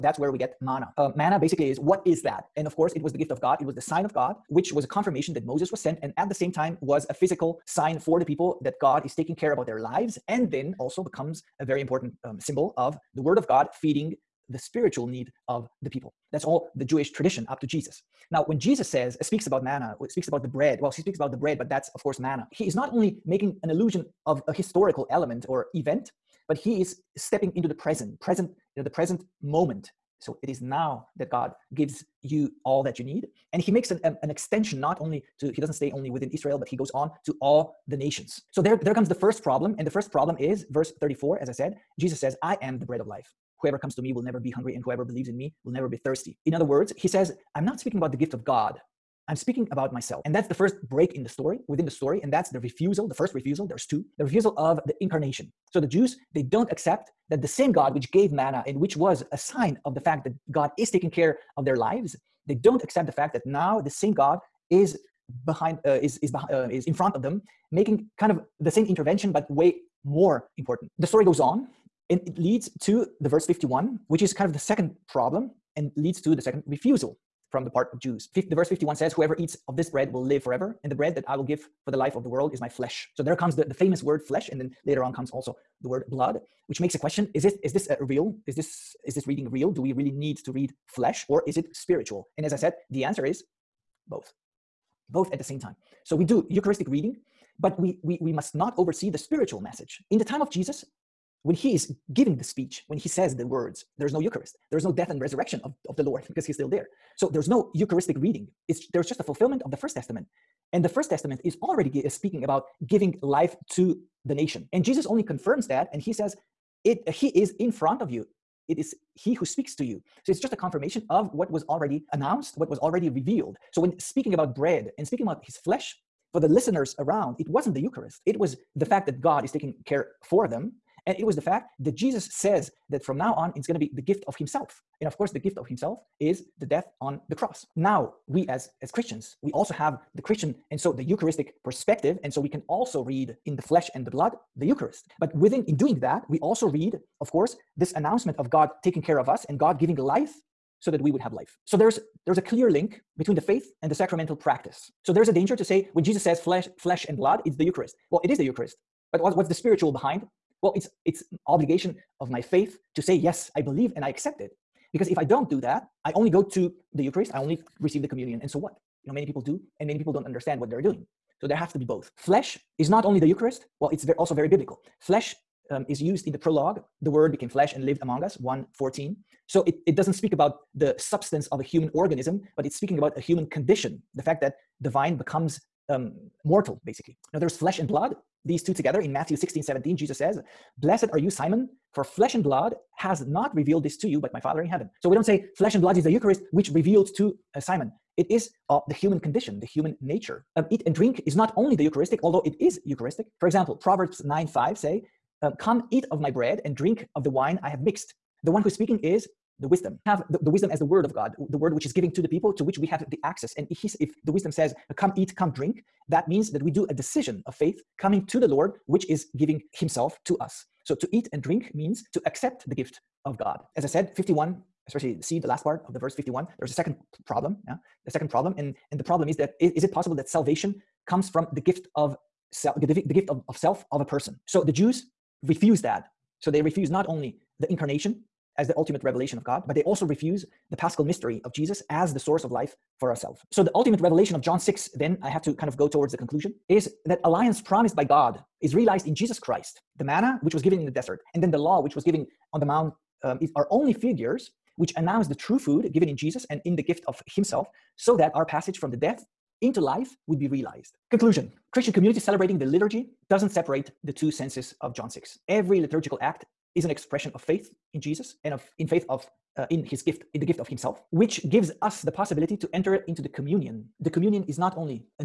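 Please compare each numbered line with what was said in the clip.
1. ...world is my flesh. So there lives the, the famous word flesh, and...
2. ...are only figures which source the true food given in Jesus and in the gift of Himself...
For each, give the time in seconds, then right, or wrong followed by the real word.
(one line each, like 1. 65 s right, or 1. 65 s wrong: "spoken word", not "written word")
1. 82 s wrong: "comes", not "lives"
2. 253 s wrong: "announce", not "source".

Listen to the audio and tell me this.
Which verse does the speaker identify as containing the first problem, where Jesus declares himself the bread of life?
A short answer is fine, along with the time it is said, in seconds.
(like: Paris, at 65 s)
34, at 40 s.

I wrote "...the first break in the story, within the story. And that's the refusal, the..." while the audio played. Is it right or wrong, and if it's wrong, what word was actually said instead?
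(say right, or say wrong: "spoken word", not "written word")
right.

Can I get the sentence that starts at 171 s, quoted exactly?
So there have to be both.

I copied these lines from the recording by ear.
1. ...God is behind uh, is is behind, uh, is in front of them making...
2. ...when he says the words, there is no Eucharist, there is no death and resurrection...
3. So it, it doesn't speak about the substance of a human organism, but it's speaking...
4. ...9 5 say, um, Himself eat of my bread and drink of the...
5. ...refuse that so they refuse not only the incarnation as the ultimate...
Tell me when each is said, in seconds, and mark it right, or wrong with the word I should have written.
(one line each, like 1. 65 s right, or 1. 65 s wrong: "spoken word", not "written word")
1. 64 s right
2. 102 s right
3. 179 s right
4. 204 s wrong: "Come", not "Himself"
5. 235 s right.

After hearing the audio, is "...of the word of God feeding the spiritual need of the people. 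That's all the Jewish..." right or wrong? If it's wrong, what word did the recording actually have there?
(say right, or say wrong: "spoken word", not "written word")
right.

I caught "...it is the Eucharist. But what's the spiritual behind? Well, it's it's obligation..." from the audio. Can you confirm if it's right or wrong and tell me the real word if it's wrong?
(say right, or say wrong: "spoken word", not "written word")
right.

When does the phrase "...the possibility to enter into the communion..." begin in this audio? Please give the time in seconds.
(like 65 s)
272 s.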